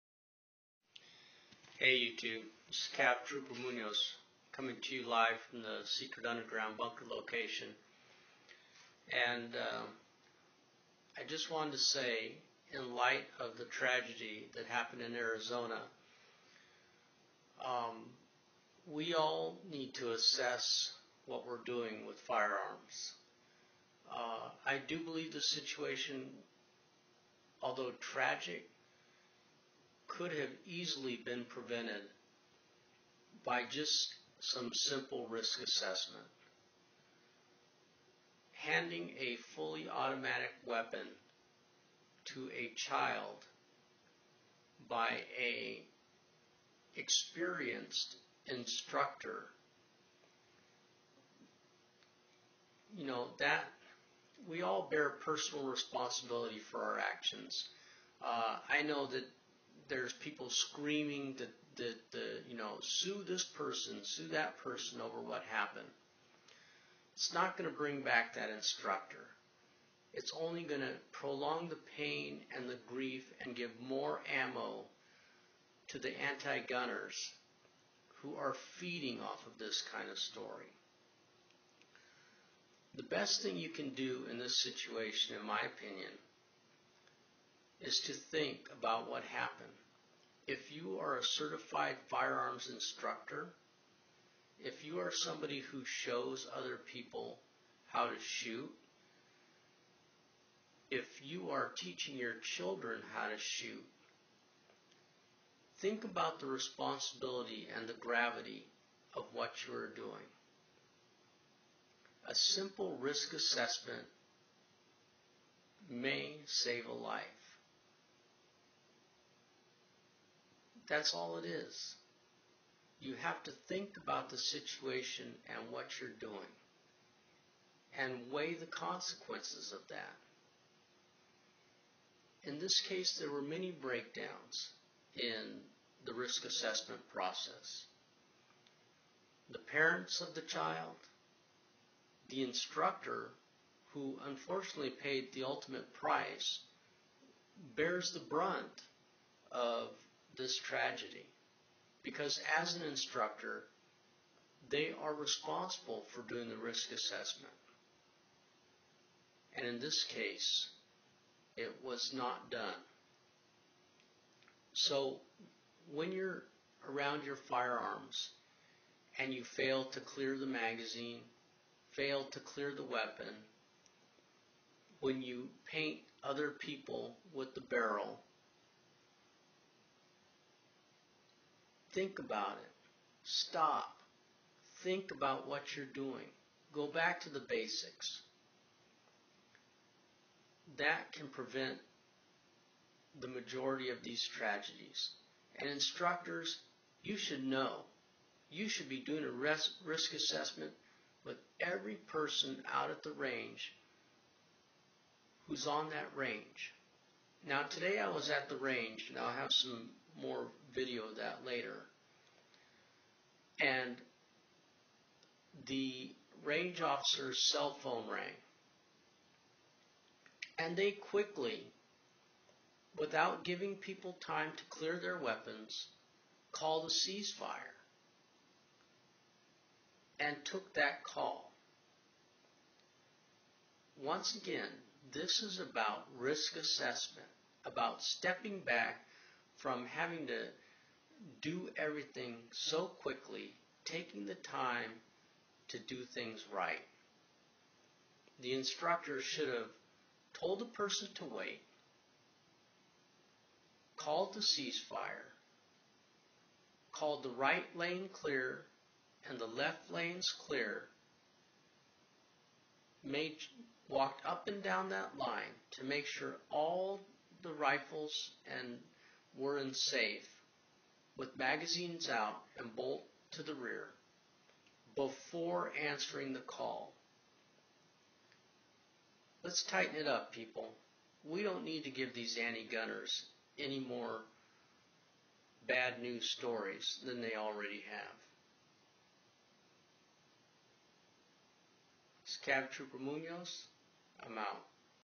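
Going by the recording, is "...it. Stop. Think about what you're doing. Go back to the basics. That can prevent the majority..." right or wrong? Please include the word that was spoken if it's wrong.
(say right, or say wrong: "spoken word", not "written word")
right.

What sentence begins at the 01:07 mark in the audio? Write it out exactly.
It's not going to bring back that instructor.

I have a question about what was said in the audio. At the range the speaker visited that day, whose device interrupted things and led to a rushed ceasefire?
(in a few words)
Range officer's cell phone.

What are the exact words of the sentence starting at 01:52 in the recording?
A simple risk assessment may save a life.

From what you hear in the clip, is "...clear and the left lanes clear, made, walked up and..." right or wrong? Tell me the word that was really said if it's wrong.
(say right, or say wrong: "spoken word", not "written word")
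right.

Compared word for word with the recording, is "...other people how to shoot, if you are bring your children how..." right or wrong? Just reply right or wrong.
wrong.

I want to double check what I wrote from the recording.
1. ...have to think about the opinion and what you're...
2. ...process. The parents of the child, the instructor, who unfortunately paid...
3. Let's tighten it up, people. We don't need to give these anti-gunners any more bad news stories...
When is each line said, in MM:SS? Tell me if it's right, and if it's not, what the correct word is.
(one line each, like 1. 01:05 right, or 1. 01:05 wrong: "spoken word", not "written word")
1. 02:03 wrong: "situation", not "opinion"
2. 02:17 right
3. 04:39 right.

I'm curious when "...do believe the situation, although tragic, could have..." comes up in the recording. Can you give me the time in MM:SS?
00:24.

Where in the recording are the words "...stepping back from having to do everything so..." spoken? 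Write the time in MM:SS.
03:58.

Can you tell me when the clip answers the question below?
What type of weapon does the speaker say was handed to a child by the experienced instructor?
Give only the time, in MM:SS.
00:39.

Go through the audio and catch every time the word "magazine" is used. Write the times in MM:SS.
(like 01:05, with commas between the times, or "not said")
02:50, 04:31.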